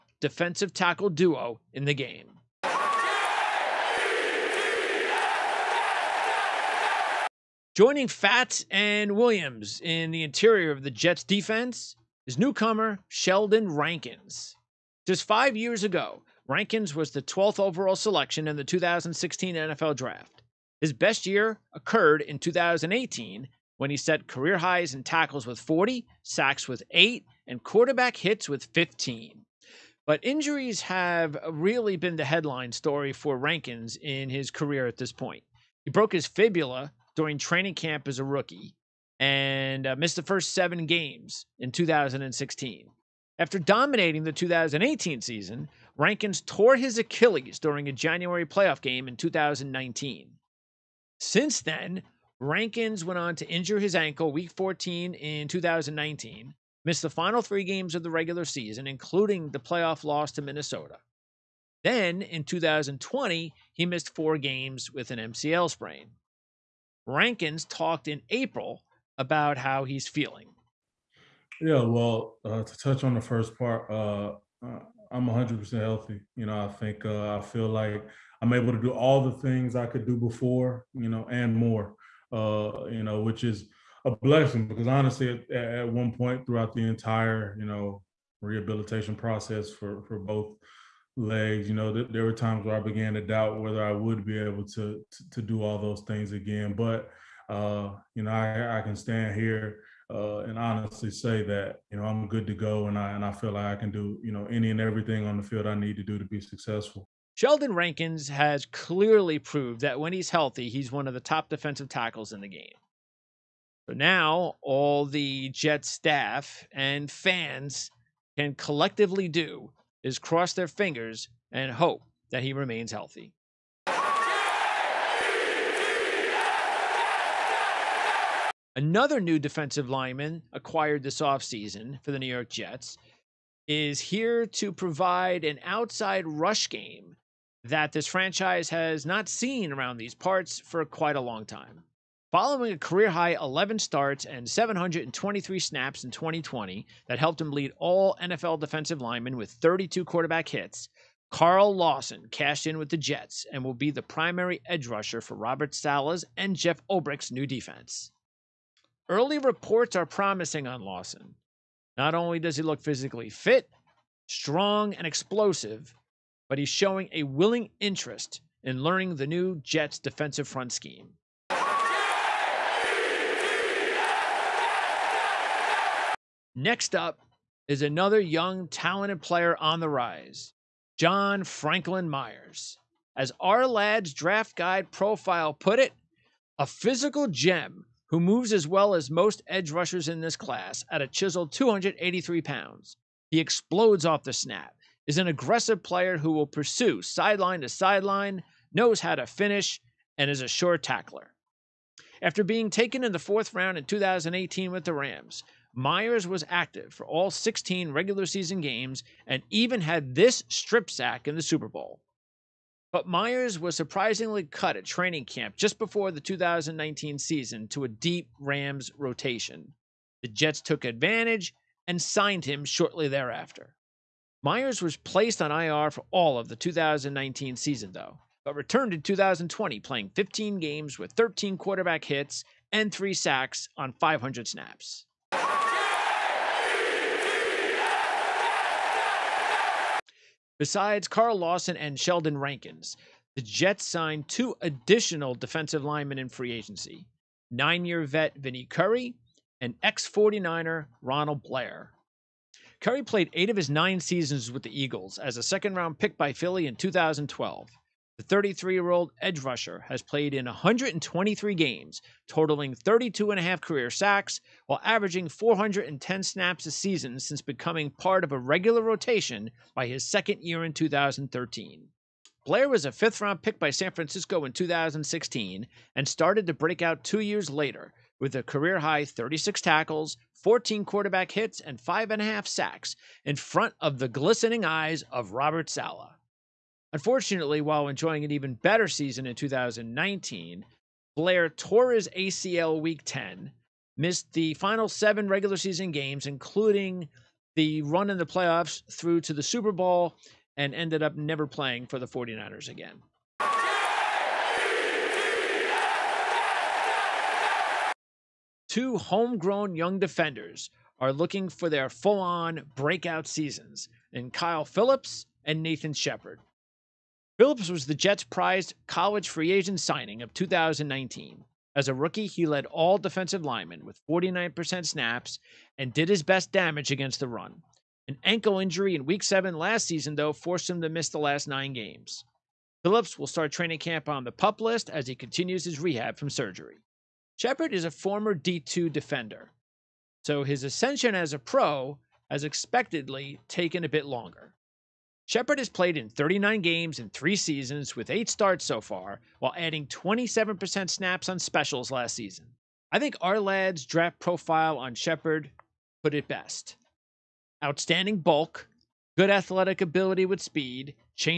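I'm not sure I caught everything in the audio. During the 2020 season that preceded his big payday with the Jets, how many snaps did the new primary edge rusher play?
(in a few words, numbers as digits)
723.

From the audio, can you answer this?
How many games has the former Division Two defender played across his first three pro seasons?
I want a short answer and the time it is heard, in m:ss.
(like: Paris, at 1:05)
39, at 5:46.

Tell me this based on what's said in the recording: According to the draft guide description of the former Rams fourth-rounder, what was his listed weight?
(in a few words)
283 pounds.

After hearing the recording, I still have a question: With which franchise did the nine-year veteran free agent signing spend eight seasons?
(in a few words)
Eagles.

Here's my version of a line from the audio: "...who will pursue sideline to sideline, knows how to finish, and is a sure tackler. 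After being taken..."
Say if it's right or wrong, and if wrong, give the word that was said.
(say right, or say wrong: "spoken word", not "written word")
right.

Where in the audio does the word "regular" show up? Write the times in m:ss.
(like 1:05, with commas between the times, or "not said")
0:58, 3:27, 4:28, 4:55.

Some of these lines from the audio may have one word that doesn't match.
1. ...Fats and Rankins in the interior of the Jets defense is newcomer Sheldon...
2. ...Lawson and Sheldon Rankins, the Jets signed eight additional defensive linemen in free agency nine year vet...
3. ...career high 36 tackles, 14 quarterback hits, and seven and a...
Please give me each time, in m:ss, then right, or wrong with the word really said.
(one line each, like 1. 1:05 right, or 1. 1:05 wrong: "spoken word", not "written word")
1. 0:08 wrong: "Williams", not "Rankins"
2. 4:01 wrong: "two", not "eight"
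3. 4:38 wrong: "five", not "seven".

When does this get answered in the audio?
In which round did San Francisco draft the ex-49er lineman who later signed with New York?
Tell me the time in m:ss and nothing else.
4:32.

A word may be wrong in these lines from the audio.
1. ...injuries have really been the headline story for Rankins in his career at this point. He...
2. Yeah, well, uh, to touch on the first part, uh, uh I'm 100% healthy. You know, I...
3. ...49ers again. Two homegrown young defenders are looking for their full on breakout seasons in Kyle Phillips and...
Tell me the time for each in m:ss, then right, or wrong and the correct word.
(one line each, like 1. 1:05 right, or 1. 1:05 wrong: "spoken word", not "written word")
1. 0:30 right
2. 1:11 right
3. 5:02 right.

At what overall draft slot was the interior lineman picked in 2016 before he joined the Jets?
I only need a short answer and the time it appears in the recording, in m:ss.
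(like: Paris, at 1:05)
12th, at 0:17.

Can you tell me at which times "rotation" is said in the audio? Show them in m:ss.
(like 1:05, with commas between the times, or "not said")
3:38, 4:28.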